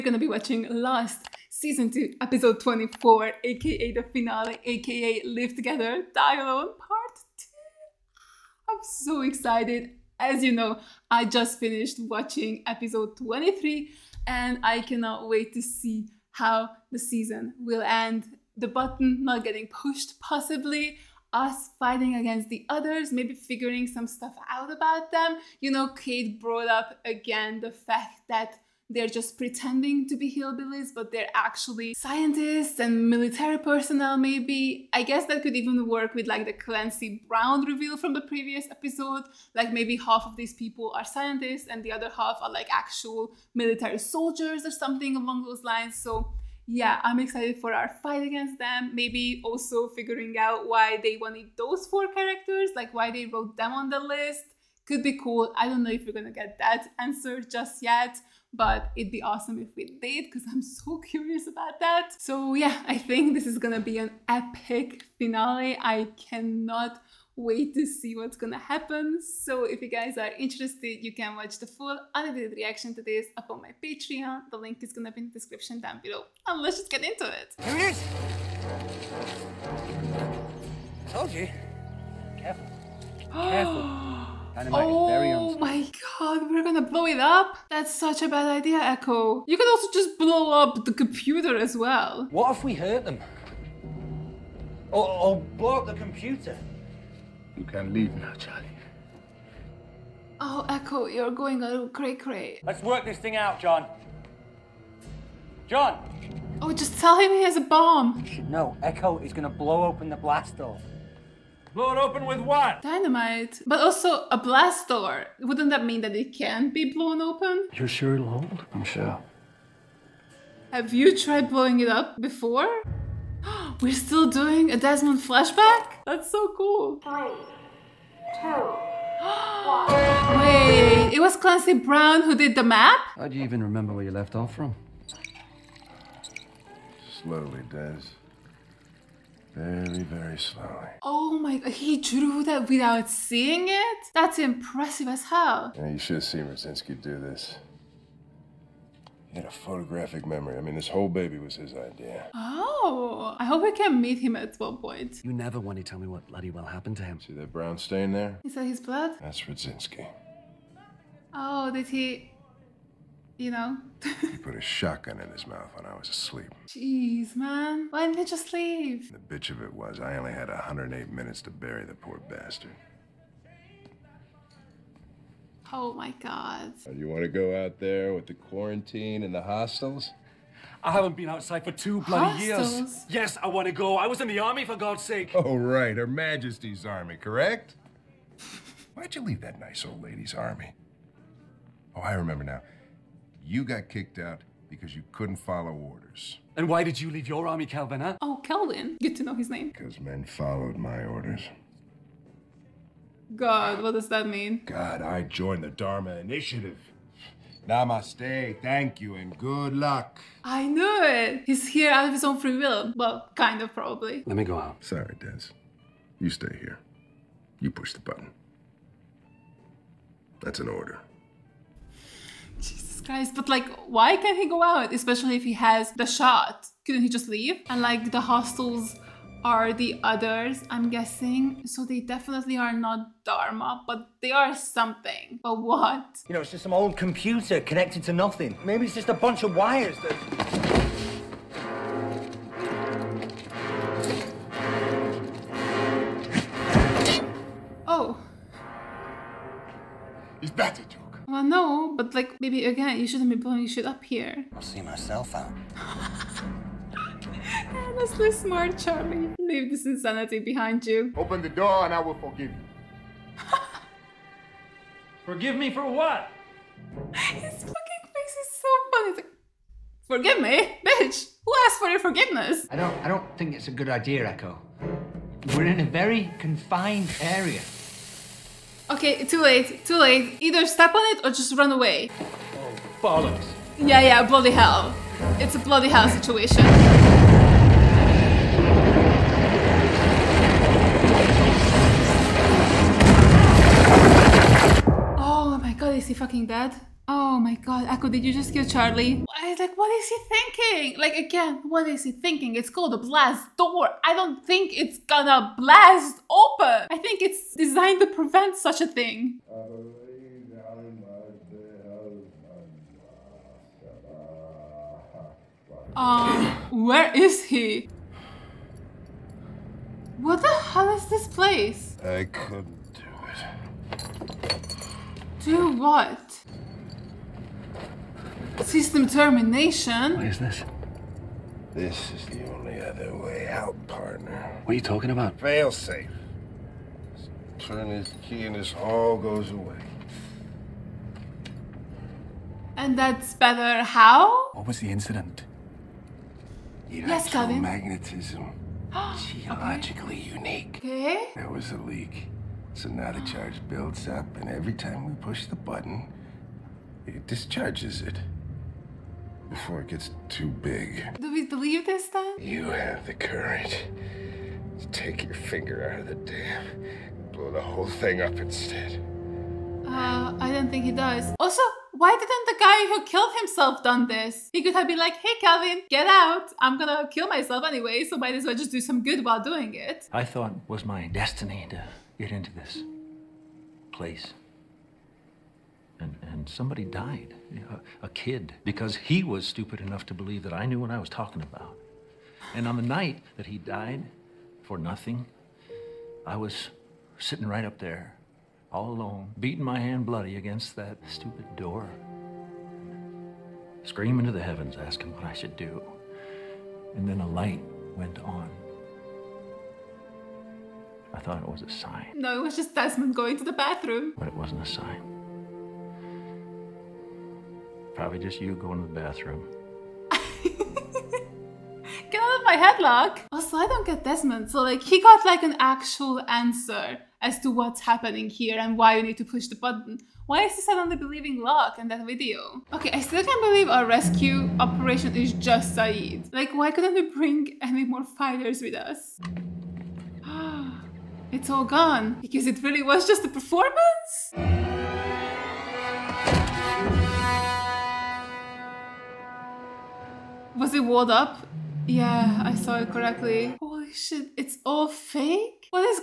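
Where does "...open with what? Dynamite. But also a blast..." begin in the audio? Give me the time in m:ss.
1:51.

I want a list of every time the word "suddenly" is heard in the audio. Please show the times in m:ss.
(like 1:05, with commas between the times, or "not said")
7:10.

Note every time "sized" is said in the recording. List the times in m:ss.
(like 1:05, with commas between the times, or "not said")
not said.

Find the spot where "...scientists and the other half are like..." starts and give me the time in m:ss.
0:41.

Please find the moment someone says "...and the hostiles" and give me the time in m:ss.
2:59.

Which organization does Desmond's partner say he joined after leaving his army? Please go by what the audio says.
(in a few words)
Dharma Initiative.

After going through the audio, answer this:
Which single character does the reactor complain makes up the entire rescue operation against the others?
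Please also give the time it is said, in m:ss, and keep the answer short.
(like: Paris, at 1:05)
Sayid, at 7:15.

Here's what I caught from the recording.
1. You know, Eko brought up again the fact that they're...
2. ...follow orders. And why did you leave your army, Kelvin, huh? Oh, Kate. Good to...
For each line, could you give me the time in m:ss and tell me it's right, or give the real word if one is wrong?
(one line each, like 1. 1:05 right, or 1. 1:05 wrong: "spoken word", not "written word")
1. 0:25 wrong: "Kate", not "Eko"
2. 3:15 wrong: "Kelvin", not "Kate".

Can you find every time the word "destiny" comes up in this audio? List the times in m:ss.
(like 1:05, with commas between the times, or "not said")
6:21.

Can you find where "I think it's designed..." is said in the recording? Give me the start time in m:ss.
5:06.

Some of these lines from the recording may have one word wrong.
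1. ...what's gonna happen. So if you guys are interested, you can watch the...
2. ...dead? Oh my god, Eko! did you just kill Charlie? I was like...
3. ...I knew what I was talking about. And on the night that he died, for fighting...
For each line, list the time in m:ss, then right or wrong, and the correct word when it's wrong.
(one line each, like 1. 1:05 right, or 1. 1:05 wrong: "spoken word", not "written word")
1. 1:08 right
2. 4:56 right
3. 6:30 wrong: "nothing", not "fighting".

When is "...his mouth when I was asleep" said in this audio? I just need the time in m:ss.
2:45.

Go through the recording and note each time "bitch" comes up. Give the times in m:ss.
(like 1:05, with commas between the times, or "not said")
2:49, 4:30.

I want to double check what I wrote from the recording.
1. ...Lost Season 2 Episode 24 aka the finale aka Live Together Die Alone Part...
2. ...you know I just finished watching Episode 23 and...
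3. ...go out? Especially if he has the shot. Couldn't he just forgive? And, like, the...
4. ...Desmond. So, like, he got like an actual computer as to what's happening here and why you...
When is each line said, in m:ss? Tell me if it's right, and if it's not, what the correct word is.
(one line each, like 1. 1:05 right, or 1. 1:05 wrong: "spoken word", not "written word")
1. 0:00 right
2. 0:10 right
3. 3:44 wrong: "leave", not "forgive"
4. 7:04 wrong: "answer", not "computer".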